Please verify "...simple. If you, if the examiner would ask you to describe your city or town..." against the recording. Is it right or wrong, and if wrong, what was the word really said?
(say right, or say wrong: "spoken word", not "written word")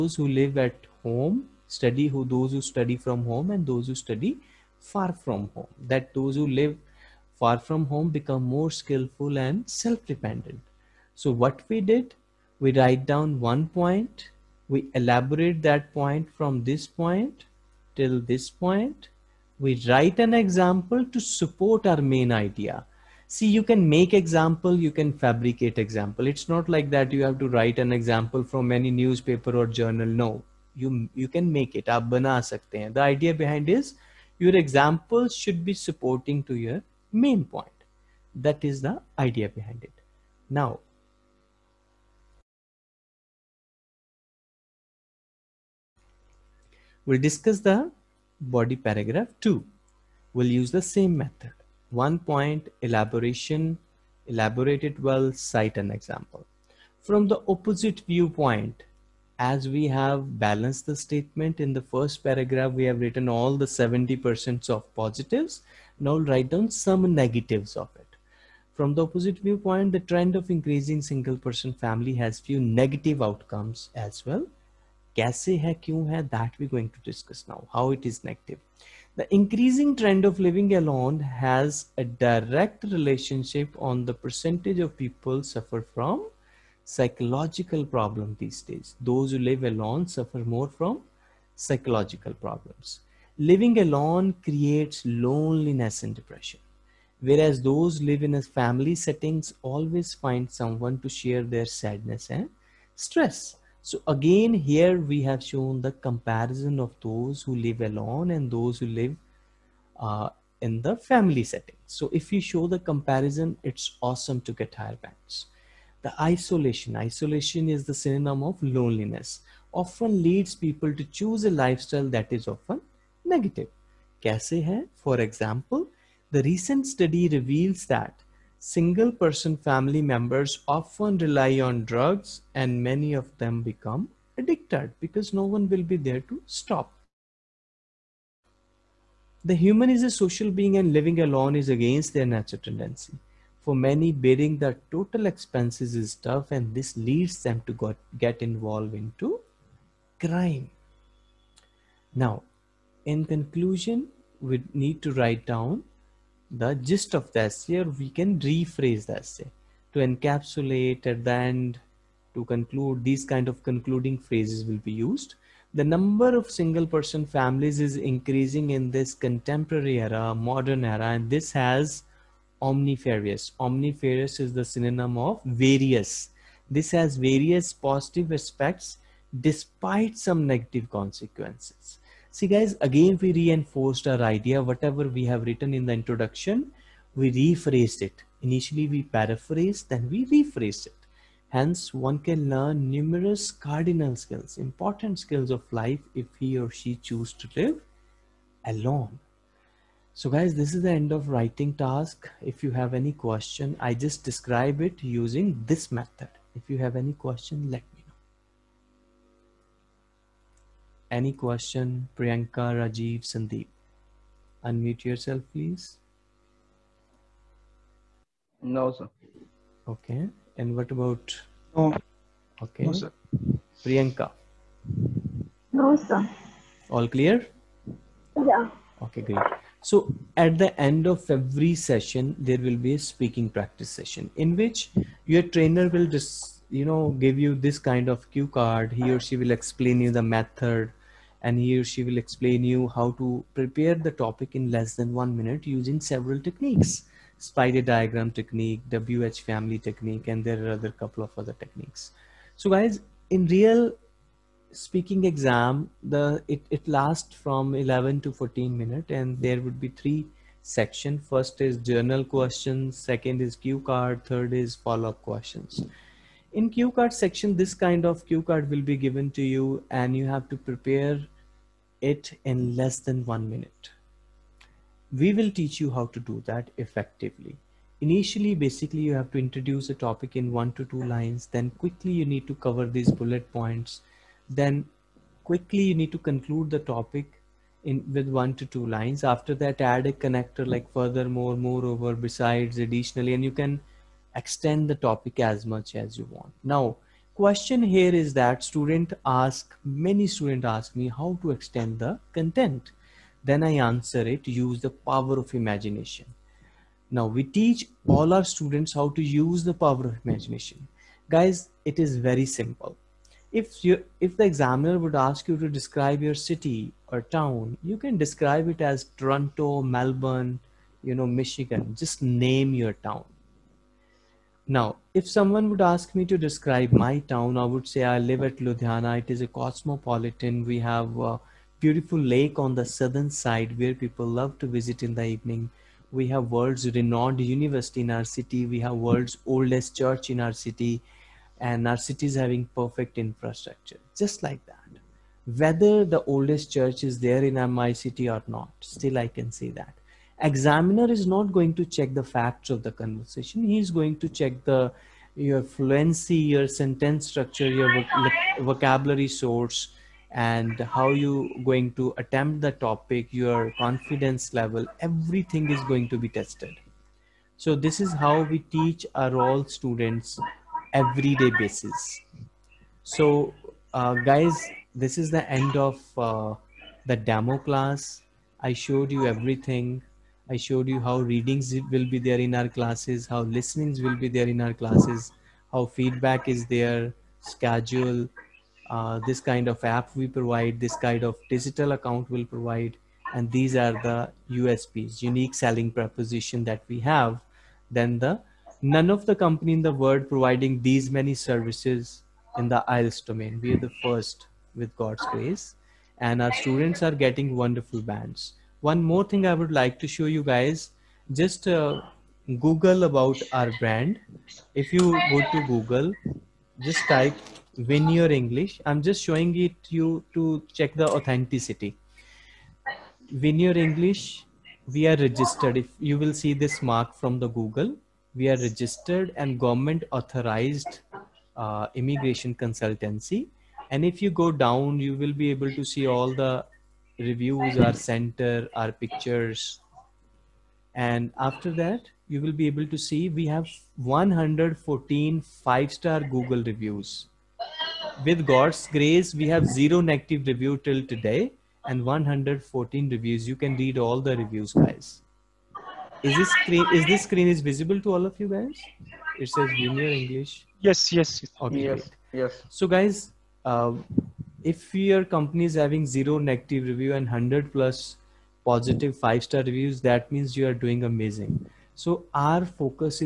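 right.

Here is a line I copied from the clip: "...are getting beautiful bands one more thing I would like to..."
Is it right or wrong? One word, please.
wrong.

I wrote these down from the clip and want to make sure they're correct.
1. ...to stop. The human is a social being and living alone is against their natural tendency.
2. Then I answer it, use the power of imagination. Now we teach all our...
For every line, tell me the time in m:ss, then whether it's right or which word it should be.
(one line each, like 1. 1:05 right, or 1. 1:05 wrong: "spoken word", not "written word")
1. 2:16 right
2. 5:03 right.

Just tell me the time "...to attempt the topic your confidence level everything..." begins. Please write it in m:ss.
6:01.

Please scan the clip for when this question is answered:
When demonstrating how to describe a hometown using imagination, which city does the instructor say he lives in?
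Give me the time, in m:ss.
5:28.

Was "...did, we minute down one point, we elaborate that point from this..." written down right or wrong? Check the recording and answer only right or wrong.
wrong.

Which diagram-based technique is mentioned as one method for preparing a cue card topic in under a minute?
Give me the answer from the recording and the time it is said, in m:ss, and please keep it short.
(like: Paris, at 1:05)
spider diagram technique, at 4:07.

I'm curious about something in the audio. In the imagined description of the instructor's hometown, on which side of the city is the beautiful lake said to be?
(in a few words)
southern side.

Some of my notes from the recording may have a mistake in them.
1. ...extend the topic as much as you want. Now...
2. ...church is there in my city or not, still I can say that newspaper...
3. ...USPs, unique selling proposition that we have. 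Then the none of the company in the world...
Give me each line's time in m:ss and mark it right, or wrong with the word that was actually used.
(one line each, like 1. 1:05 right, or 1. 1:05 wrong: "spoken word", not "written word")
1. 4:54 right
2. 5:46 wrong: "examiner", not "newspaper"
3. 6:34 right.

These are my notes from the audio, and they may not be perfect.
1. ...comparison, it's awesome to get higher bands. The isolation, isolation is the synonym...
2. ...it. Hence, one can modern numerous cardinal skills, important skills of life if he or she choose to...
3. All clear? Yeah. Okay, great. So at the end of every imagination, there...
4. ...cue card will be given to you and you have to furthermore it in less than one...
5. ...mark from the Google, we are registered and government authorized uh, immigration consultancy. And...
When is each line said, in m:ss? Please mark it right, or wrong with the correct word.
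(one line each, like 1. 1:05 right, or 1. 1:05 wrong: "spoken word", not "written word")
1. 1:52 right
2. 3:10 wrong: "learn", not "modern"
3. 3:46 wrong: "session", not "imagination"
4. 4:28 wrong: "prepare", not "furthermore"
5. 7:06 right.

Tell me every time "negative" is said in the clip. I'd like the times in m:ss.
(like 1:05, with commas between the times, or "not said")
1:07, 1:12, 2:03, 3:00, 7:30, 7:46.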